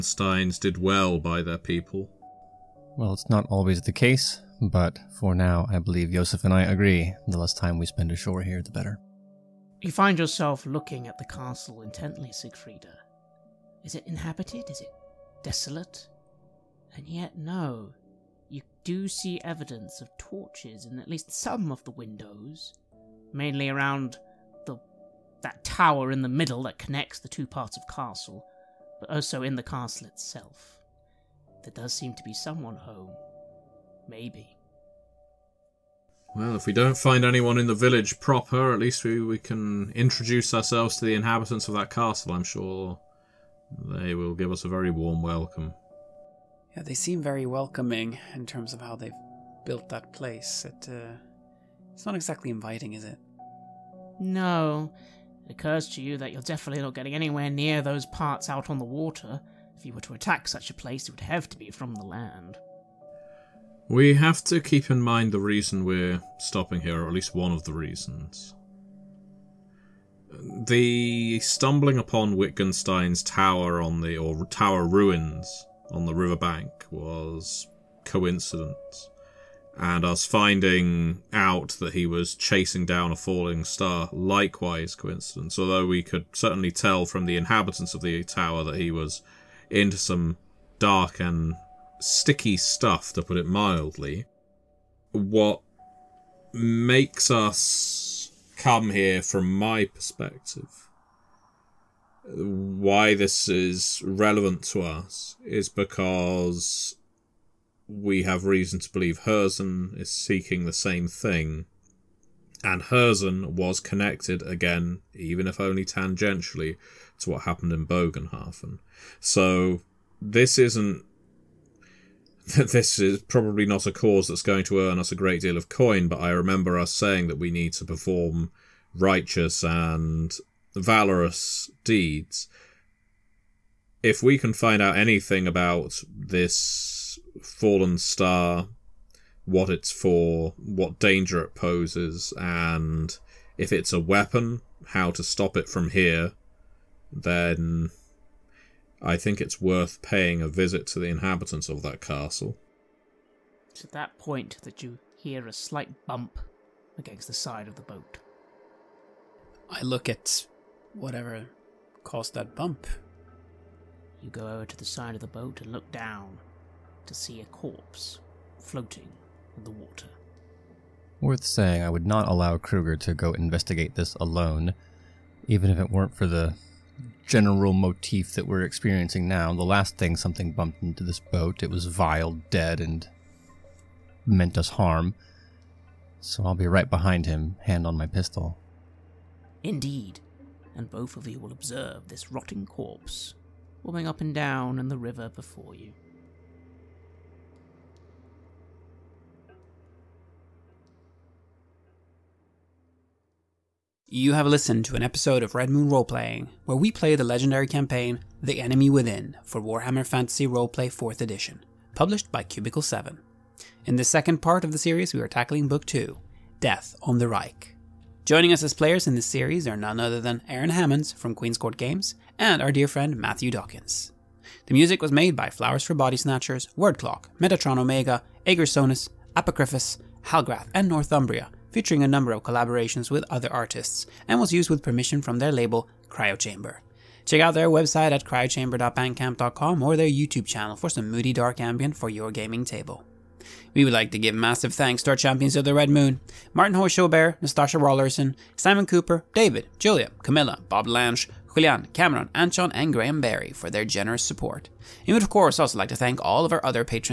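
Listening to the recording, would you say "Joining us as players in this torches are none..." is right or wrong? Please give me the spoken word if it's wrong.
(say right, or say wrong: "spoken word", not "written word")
wrong: "series", not "torches".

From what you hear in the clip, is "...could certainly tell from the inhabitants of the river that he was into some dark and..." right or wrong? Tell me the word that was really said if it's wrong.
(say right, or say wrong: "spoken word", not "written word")
wrong: "tower", not "river".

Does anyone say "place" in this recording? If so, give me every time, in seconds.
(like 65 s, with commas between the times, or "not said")
50 s, 60 s.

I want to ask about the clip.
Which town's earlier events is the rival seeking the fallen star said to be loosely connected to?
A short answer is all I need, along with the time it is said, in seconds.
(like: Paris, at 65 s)
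Bogenhafen, at 117 s.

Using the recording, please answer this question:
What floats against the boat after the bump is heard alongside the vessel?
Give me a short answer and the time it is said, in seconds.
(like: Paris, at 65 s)
A corpse, at 167 s.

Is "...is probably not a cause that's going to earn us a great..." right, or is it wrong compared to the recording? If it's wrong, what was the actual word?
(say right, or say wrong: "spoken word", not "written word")
right.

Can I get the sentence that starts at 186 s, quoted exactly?
So I'll be right behind him, hand on my pistol.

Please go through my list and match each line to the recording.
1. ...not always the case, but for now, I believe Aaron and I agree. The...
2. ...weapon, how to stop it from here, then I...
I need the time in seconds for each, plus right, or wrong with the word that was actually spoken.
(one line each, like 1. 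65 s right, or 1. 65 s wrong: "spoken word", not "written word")
1. 3 s wrong: "Joseph", not "Aaron"
2. 143 s right.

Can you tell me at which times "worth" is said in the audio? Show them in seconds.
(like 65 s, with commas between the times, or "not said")
149 s, 171 s.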